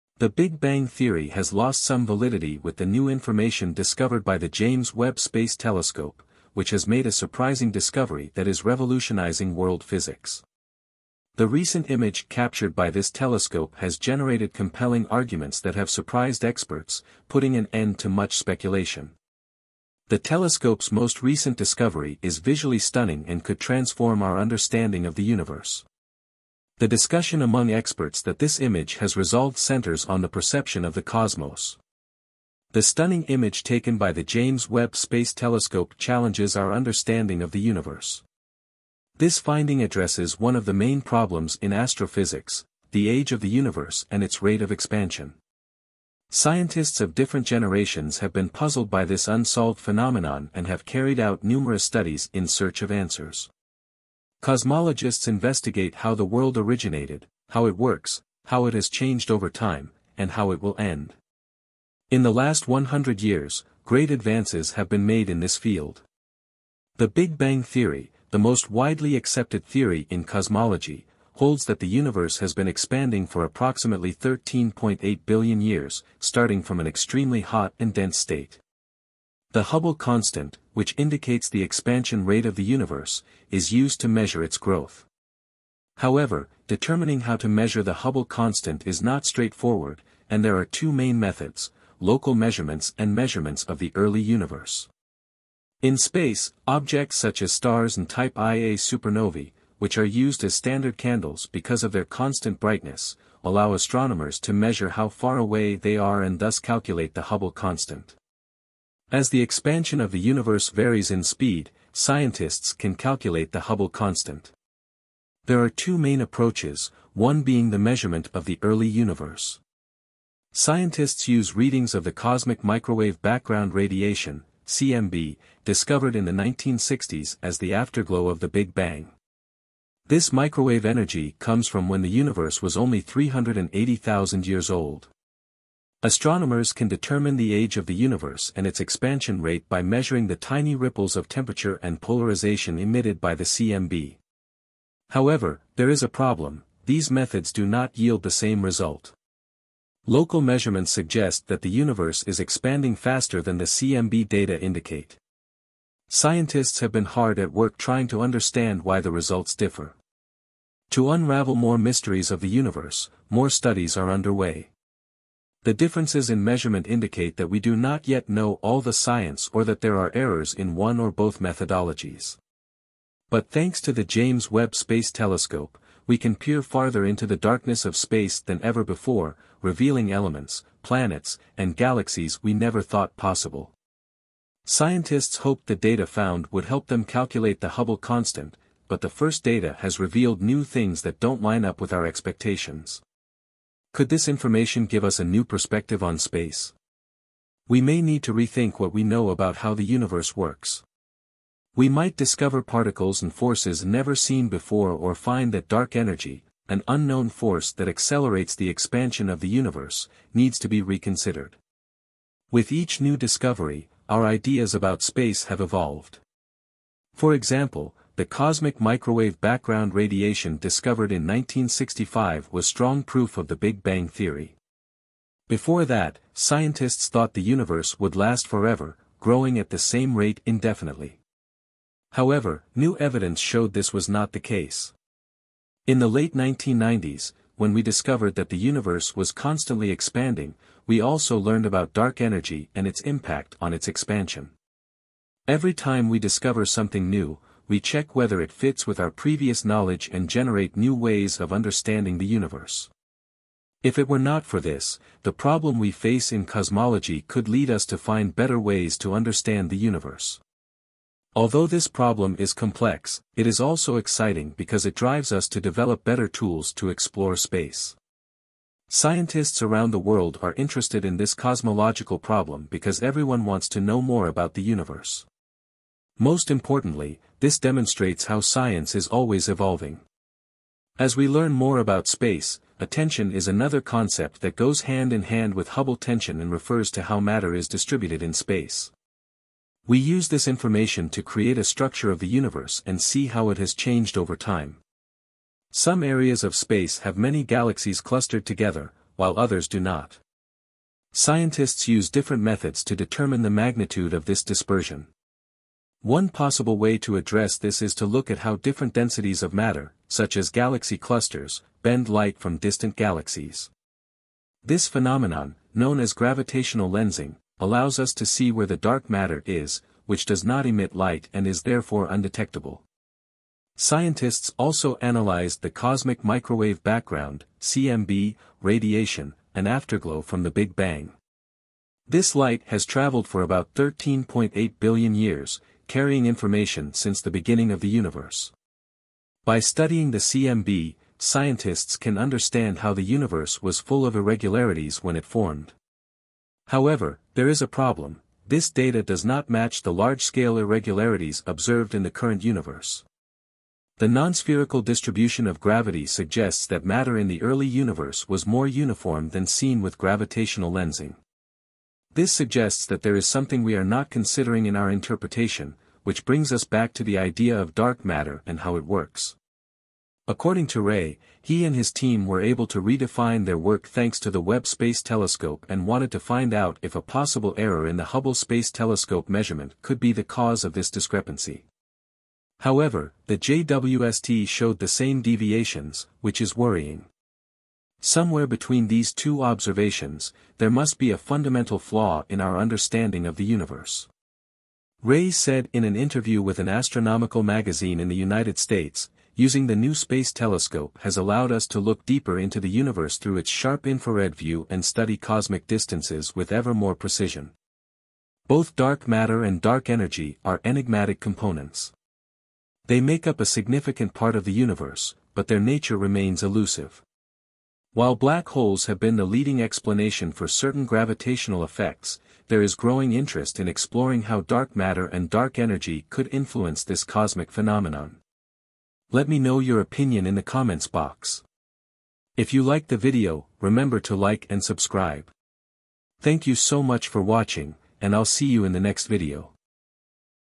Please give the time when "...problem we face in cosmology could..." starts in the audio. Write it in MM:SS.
04:15.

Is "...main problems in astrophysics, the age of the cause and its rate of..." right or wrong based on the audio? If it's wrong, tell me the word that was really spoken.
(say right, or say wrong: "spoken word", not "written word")
wrong: "universe", not "cause".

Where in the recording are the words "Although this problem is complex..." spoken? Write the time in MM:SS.
04:21.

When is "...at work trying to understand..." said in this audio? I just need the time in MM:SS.
02:37.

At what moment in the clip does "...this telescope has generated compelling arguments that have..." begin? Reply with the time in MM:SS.
00:12.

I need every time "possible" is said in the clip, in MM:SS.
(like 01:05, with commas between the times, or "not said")
03:03, 05:06, 06:17.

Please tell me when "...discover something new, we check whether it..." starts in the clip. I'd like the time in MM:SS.
04:06.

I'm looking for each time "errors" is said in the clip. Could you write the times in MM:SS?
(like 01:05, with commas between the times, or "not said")
02:50, 06:17.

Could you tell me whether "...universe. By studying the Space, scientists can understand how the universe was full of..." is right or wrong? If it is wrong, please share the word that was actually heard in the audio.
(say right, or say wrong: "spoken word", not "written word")
wrong: "CMB", not "Space".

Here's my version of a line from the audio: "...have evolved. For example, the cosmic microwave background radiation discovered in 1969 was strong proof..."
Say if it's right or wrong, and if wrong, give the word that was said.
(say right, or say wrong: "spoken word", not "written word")
wrong: "1965", not "1969".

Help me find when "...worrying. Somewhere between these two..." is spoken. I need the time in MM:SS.
06:26.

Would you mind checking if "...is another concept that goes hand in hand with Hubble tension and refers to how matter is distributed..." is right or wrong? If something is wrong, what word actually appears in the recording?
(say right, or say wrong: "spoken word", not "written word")
right.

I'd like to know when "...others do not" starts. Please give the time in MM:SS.
04:59.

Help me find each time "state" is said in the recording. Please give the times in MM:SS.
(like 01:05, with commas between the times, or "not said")
01:18, 06:38.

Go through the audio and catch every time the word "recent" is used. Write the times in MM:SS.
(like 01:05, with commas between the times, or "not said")
00:11, 00:21.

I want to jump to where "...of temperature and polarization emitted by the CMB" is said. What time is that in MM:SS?
02:21.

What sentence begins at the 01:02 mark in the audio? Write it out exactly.
In the last 100 years, great advances have been made in this field.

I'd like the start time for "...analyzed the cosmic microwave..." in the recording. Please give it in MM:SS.
05:25.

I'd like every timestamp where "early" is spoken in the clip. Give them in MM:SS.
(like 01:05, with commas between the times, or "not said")
01:33, 01:58, 05:57.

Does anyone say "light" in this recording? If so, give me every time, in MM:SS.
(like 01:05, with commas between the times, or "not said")
05:12, 05:20, 05:32.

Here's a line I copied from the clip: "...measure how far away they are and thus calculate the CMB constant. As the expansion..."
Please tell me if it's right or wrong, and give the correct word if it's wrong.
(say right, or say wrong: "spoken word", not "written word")
wrong: "Hubble", not "CMB".